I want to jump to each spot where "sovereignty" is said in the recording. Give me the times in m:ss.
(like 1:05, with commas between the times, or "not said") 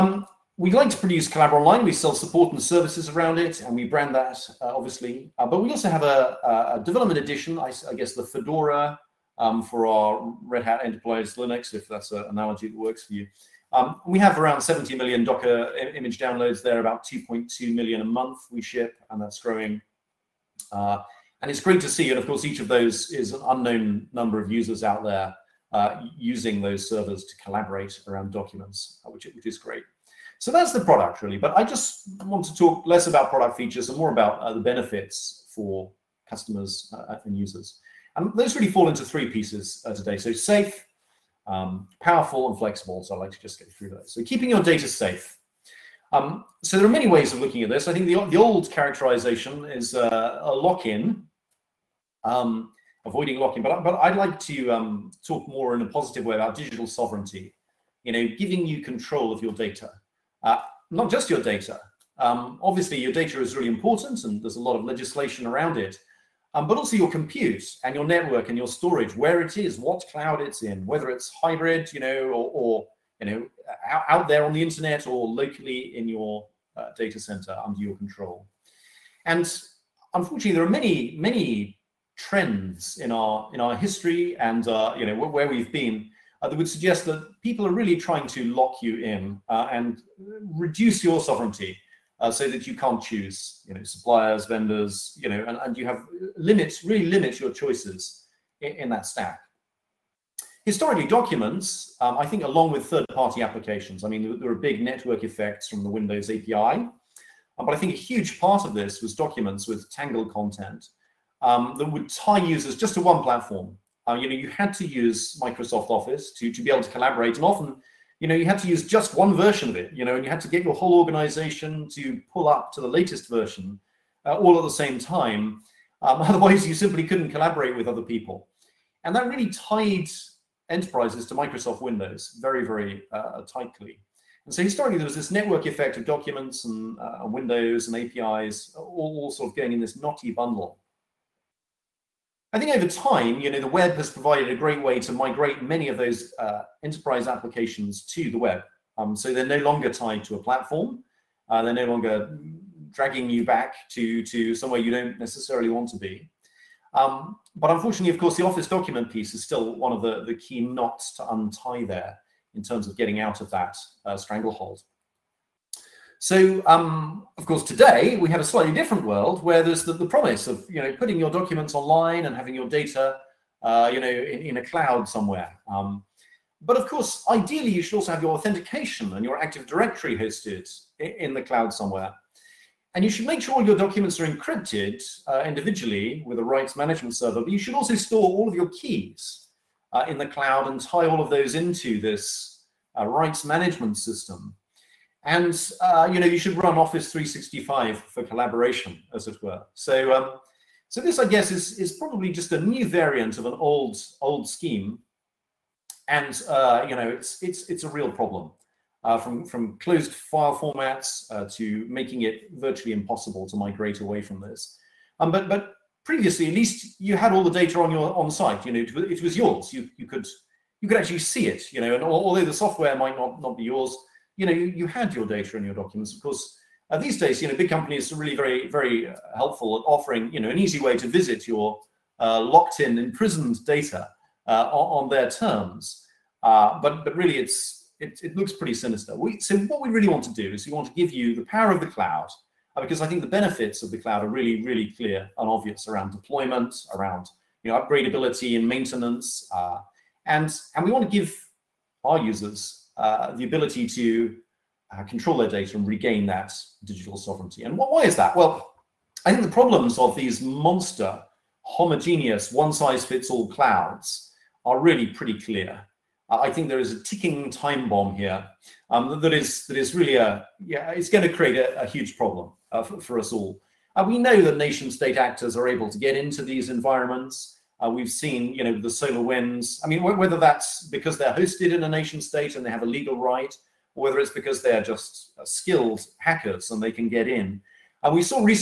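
0:56, 1:31, 4:17.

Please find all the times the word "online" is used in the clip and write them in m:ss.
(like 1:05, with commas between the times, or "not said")
0:01, 2:51.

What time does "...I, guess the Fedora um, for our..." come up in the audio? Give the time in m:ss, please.
0:07.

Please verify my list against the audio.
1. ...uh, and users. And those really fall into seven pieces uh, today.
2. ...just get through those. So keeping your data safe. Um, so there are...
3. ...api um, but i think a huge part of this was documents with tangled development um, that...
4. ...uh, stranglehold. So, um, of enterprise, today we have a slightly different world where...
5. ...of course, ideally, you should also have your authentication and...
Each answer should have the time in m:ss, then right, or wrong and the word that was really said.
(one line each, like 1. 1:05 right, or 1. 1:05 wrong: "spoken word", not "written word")
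1. 0:36 wrong: "three", not "seven"
2. 0:43 right
3. 1:46 wrong: "content", not "development"
4. 2:44 wrong: "course", not "enterprise"
5. 2:56 right.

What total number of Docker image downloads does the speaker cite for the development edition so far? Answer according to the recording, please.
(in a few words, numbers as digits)
70 million.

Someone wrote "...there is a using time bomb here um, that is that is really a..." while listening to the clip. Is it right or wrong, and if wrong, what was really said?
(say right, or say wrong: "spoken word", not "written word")
wrong: "ticking", not "using".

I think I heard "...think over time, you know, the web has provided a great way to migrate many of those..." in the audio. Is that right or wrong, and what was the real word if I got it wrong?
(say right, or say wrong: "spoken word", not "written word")
right.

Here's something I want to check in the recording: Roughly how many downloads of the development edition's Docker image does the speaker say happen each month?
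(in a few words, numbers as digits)
2.2 million.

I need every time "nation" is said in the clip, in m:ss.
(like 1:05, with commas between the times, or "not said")
4:34, 4:41.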